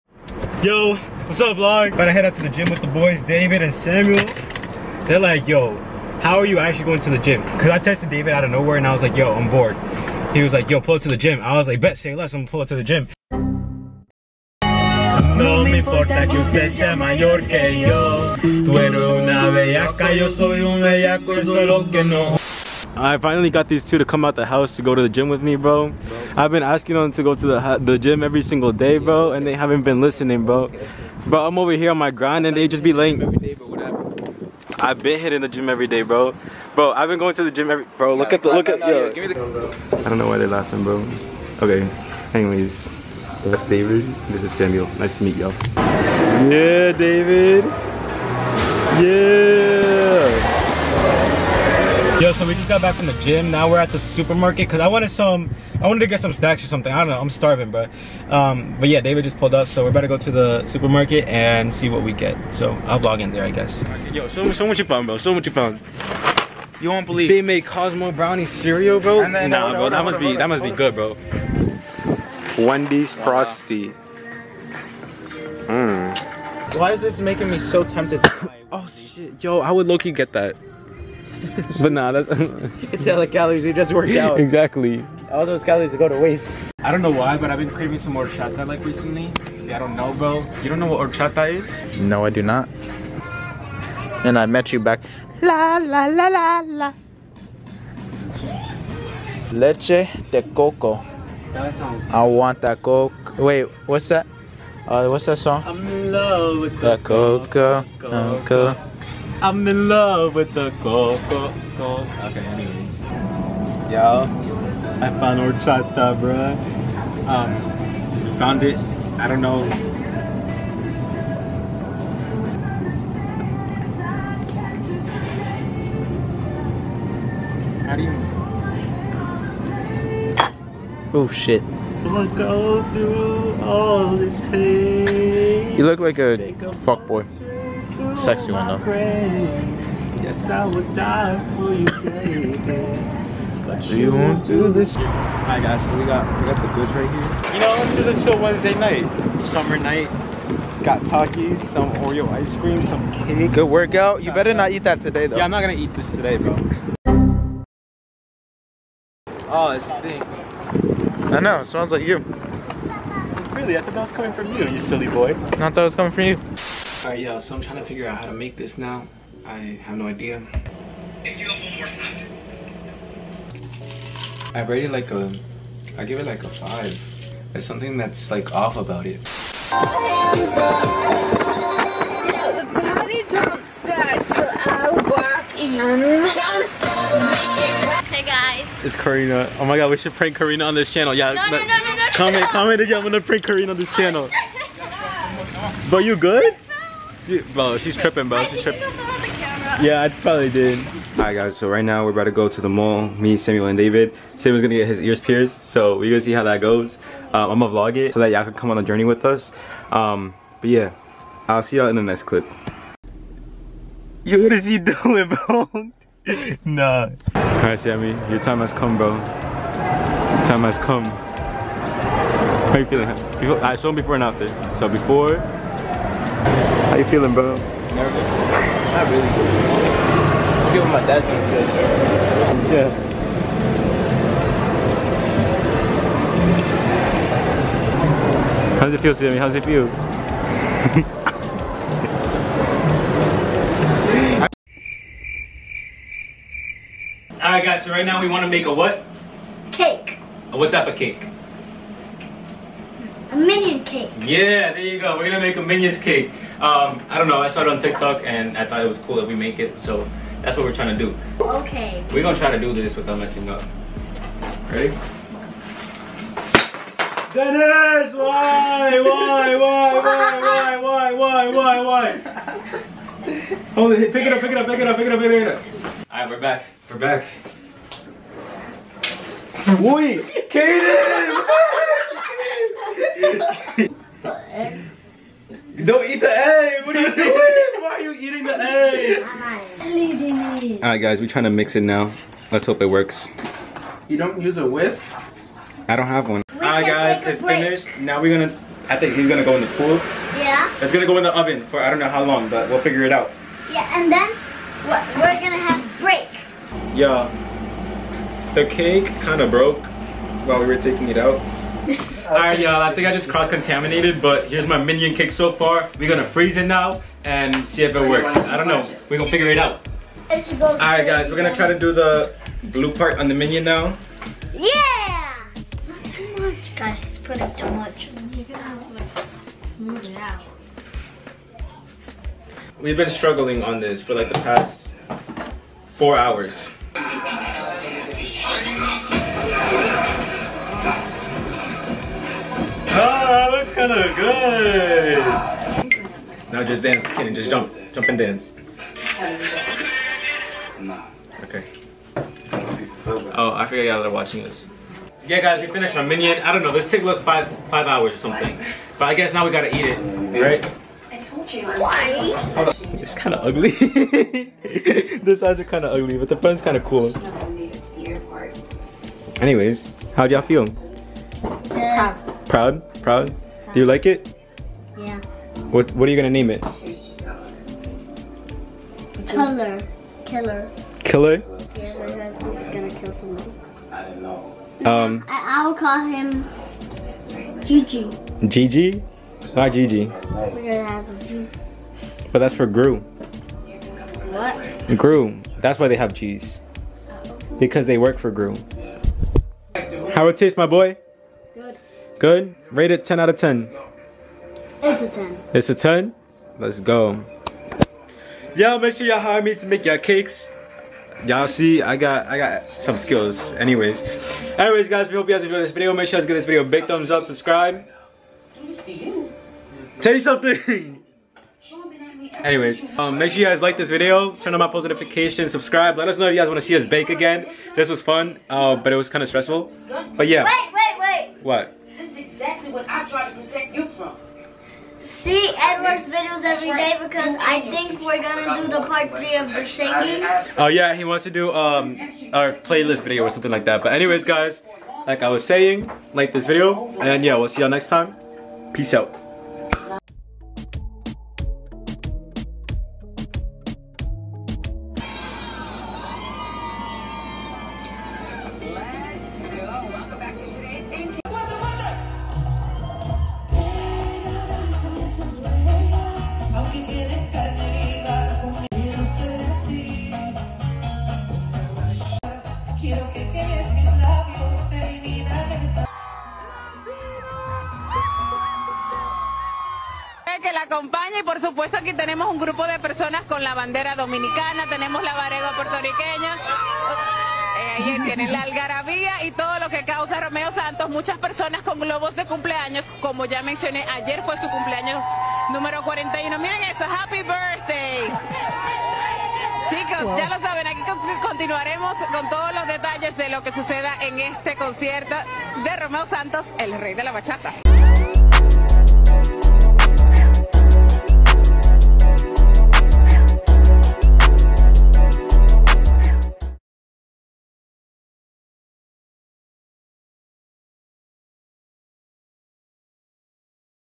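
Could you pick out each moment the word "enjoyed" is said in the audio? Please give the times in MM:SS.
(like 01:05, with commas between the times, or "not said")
06:55.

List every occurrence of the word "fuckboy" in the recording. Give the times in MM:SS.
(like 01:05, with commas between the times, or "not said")
02:16.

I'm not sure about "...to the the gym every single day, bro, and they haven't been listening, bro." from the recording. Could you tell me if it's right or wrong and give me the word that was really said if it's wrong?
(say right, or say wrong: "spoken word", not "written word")
right.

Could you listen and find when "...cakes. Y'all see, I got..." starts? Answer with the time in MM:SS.
06:49.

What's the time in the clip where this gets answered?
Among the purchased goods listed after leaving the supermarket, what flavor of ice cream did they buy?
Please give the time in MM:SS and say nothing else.
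02:31.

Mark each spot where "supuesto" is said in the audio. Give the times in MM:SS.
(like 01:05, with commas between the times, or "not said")
08:01.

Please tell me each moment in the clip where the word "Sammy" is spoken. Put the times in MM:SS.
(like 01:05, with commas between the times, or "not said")
03:37, 03:59.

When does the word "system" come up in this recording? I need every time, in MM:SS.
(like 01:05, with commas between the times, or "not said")
not said.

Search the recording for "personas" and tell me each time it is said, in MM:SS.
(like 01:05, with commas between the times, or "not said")
08:02, 08:11.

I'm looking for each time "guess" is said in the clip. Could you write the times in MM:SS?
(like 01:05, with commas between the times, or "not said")
01:03, 05:59.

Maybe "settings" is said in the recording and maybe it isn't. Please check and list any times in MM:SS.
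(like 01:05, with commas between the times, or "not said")
not said.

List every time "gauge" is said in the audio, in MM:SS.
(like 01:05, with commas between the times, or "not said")
not said.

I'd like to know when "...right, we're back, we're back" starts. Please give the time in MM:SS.
04:36.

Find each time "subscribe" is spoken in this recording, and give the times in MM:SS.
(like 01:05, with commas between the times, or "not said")
06:57, 07:05.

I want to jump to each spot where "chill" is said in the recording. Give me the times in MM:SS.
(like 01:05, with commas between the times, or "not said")
02:28.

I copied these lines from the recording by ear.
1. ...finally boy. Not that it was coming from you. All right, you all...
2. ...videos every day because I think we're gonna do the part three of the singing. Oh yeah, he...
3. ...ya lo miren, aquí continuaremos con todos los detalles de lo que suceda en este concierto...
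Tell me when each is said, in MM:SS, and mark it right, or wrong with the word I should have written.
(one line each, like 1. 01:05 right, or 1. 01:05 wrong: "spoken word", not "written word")
1. 02:44 wrong: "silly", not "finally"
2. 07:16 right
3. 08:20 wrong: "saben", not "miren".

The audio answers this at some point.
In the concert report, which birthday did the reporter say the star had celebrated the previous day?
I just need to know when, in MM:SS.
08:15.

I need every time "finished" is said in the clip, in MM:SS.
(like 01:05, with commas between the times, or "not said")
04:57, 05:55.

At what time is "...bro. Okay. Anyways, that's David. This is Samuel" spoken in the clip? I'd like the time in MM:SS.
00:40.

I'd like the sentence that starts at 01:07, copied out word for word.
They make Cosmic Brownie cereal, bro.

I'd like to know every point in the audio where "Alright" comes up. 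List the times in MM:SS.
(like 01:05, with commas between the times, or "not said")
02:24, 03:21, 03:37, 04:07, 05:11, 05:20.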